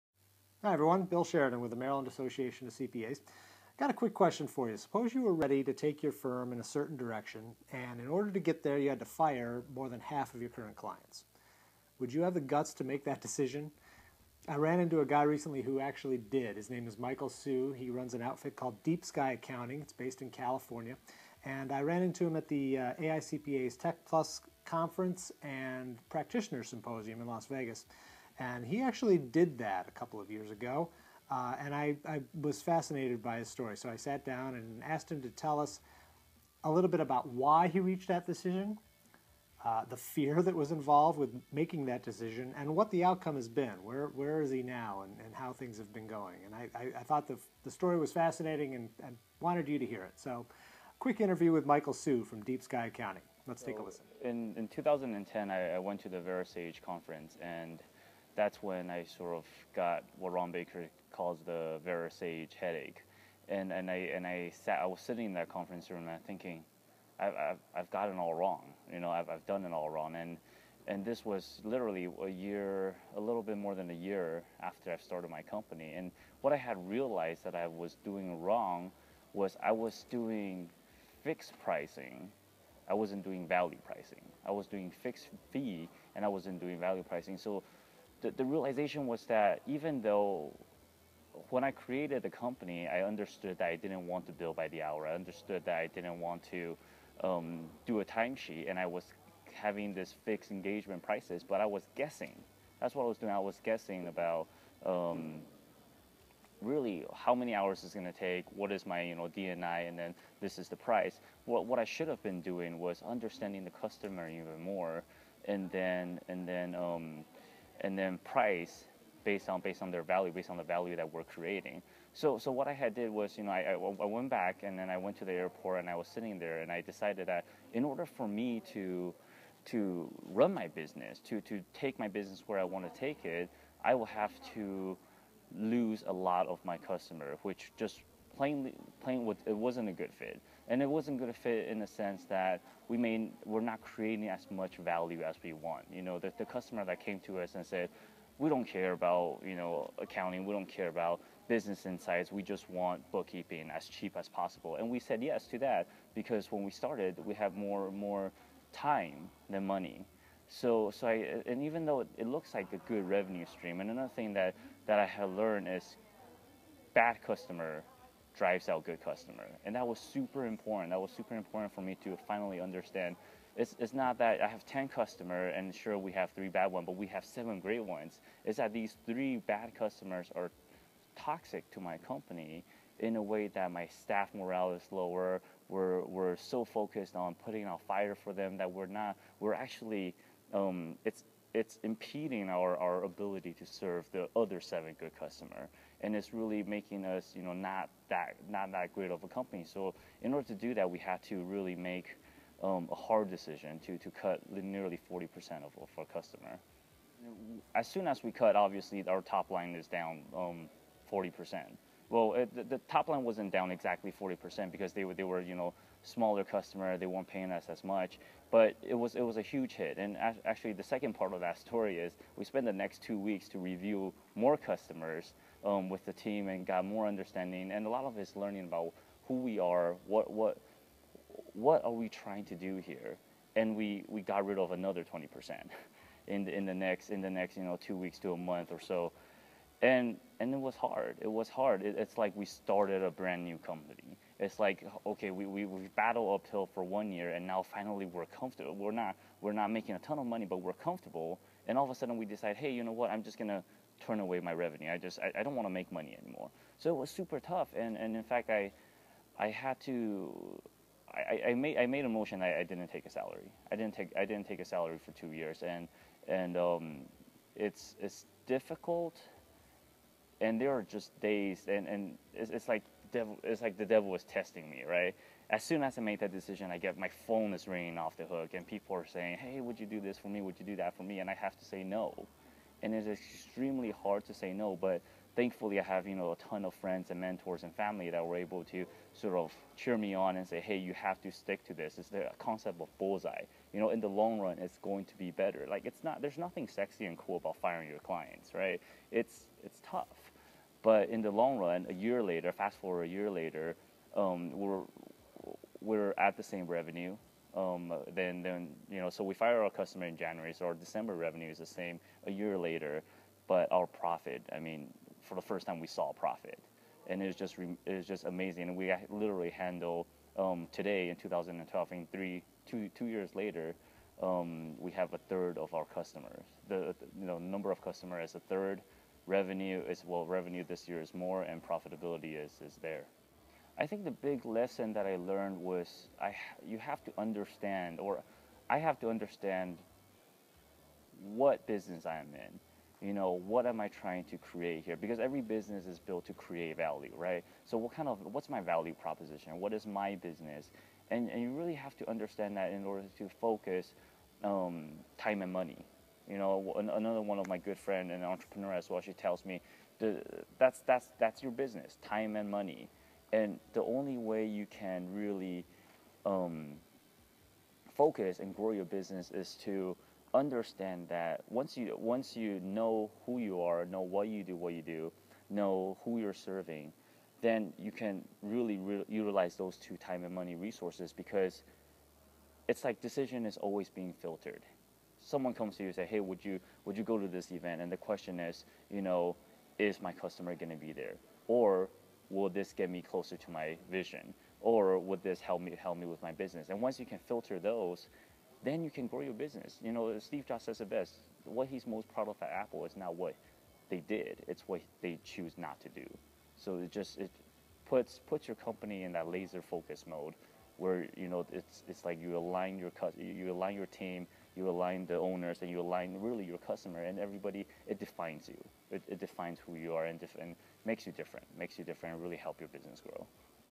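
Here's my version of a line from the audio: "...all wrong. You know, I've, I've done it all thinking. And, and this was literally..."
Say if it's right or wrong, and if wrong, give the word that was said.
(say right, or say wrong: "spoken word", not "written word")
wrong: "wrong", not "thinking".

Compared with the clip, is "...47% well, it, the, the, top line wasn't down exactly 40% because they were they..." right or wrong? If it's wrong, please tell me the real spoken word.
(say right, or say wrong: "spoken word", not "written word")
wrong: "40", not "47".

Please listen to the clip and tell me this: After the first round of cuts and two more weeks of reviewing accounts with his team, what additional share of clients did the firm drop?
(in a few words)
20%.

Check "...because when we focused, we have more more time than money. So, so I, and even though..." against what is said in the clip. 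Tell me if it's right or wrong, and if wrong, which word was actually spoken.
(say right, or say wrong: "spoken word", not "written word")
wrong: "started", not "focused".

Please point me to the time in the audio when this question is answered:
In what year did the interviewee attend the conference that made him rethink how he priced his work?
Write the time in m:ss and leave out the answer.
0:54.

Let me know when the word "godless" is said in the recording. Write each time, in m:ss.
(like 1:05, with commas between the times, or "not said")
not said.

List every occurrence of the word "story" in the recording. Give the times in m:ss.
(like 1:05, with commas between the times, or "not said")
0:33, 0:47, 3:41.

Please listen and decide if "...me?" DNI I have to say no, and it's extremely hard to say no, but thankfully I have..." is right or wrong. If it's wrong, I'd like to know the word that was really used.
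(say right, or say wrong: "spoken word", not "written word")
wrong: "And", not "DNI".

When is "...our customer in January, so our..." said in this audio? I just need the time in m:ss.
5:09.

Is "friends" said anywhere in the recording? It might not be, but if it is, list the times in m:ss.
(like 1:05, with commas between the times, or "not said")
4:46, 5:57.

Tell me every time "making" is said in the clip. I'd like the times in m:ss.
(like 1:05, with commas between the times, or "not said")
0:41, 3:16, 4:09.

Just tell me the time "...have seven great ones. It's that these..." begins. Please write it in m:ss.
2:57.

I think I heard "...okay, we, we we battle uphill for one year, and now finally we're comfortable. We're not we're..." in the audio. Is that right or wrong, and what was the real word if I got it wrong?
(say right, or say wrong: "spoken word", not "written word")
right.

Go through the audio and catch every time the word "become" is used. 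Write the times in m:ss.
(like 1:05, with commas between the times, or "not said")
not said.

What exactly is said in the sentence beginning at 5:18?
And we literally handle um, today in 2012, and three two two years later, um, we have a third of our customers.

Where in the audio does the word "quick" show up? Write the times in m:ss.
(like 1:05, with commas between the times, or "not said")
0:03, 0:50.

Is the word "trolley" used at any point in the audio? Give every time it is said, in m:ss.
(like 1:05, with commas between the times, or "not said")
not said.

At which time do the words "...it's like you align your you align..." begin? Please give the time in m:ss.
6:51.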